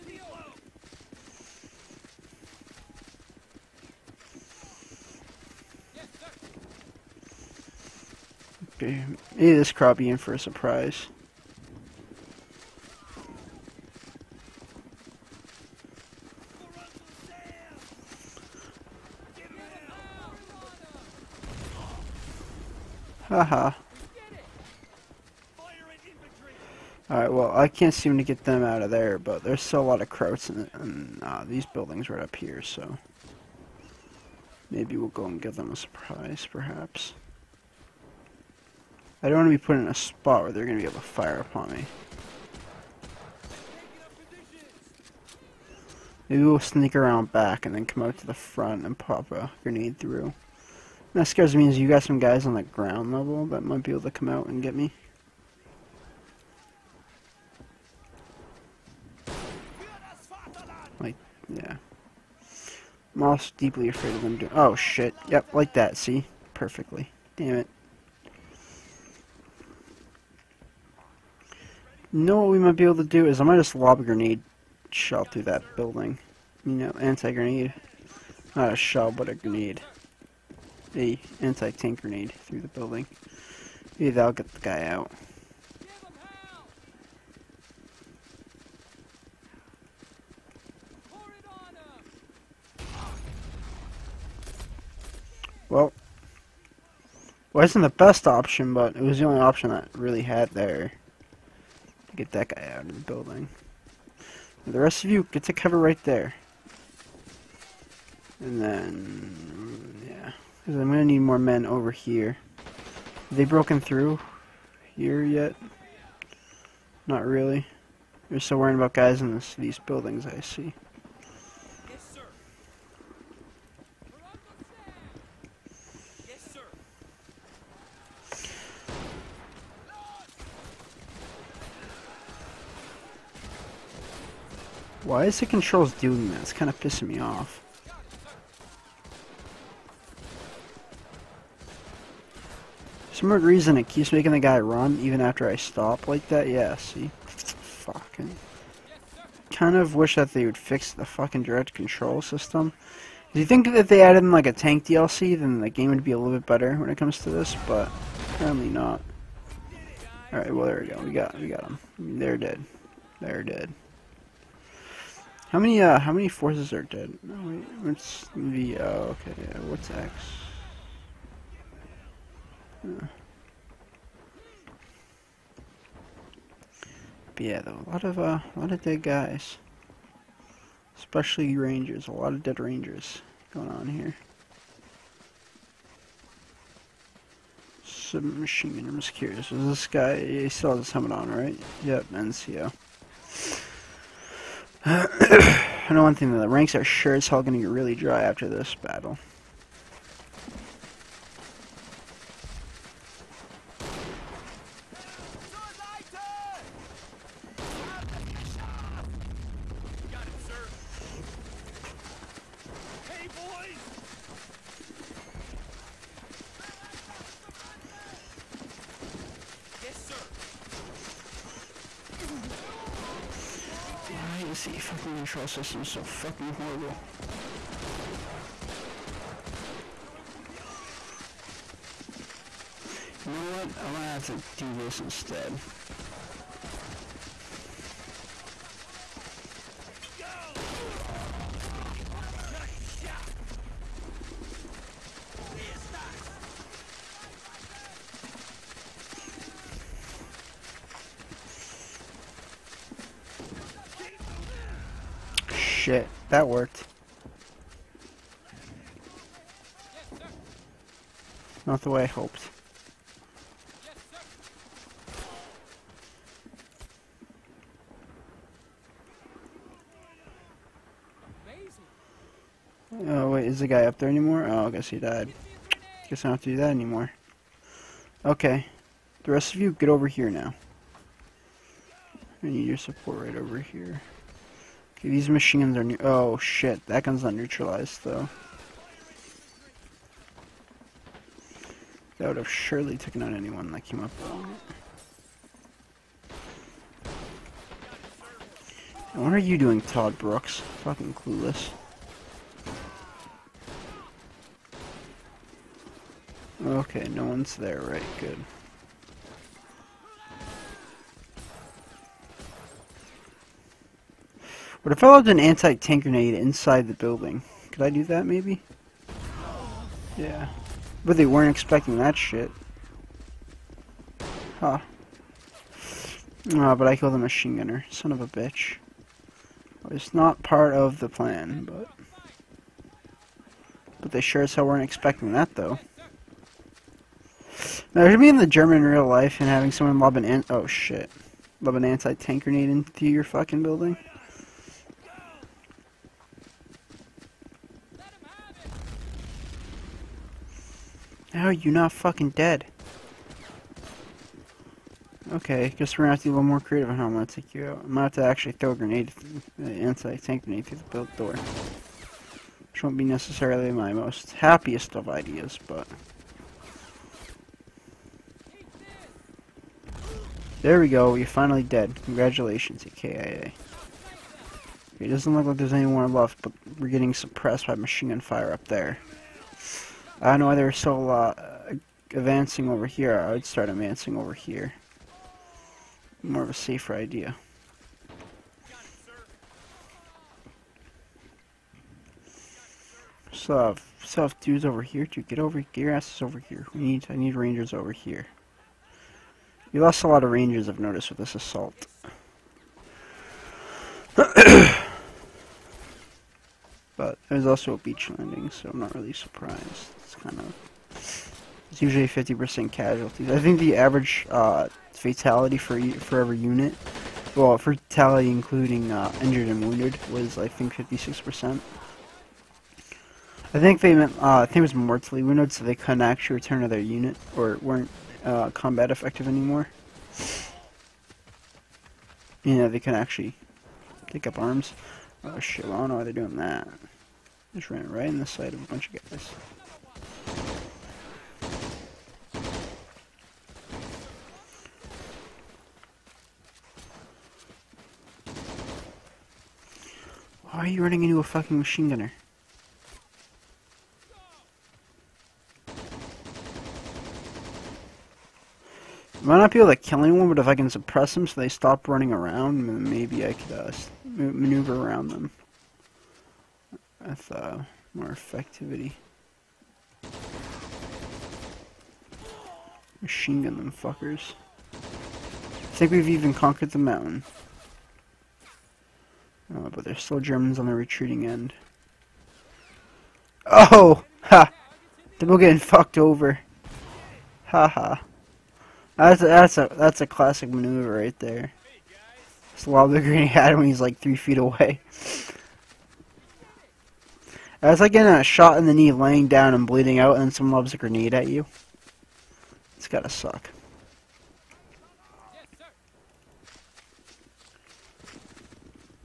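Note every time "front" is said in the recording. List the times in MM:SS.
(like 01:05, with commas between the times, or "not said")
00:48.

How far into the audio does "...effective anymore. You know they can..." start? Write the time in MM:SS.
07:08.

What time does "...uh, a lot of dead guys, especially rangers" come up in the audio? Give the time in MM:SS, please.
02:58.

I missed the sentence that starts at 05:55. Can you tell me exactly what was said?
Okay, guess we're gonna have to be a little more creative on how I'm gonna take you out.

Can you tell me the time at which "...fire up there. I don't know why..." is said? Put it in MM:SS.
06:18.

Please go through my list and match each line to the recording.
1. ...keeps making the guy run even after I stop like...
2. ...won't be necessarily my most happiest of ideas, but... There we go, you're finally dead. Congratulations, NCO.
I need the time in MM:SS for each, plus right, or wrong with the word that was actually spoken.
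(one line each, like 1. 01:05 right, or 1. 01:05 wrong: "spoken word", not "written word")
1. 02:23 right
2. 06:02 wrong: "AKIA", not "NCO".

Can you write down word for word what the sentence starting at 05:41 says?
Lob an anti-tank grenade into your fucking building.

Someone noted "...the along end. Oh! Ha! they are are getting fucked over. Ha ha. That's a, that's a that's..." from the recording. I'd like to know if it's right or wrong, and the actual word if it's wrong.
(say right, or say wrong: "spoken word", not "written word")
wrong: "retreating", not "along".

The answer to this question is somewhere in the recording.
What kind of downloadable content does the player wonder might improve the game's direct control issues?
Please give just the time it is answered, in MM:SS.
02:34.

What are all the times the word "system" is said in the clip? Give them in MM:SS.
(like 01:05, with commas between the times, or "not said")
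02:32, 03:45.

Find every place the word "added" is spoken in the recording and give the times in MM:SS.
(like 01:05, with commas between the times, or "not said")
02:34.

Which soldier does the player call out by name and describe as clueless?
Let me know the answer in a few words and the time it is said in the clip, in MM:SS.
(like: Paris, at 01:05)
Todd Brooks, at 04:59.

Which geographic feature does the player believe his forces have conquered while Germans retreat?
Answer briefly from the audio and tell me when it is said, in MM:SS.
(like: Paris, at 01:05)
The mountain, at 07:56.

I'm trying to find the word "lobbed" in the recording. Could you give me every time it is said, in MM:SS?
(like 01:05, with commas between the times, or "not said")
05:15.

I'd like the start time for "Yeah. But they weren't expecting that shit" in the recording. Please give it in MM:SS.
05:20.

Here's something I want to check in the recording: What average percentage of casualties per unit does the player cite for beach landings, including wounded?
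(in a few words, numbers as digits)
56%.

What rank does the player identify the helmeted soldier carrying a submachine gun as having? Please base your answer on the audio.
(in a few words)
NCO.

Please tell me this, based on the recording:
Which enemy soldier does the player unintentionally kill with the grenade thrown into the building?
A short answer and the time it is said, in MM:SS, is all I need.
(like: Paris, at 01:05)
The machine gunner, at 05:27.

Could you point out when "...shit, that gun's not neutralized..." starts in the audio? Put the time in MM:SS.
04:46.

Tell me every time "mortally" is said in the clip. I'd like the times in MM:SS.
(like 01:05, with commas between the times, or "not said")
07:04.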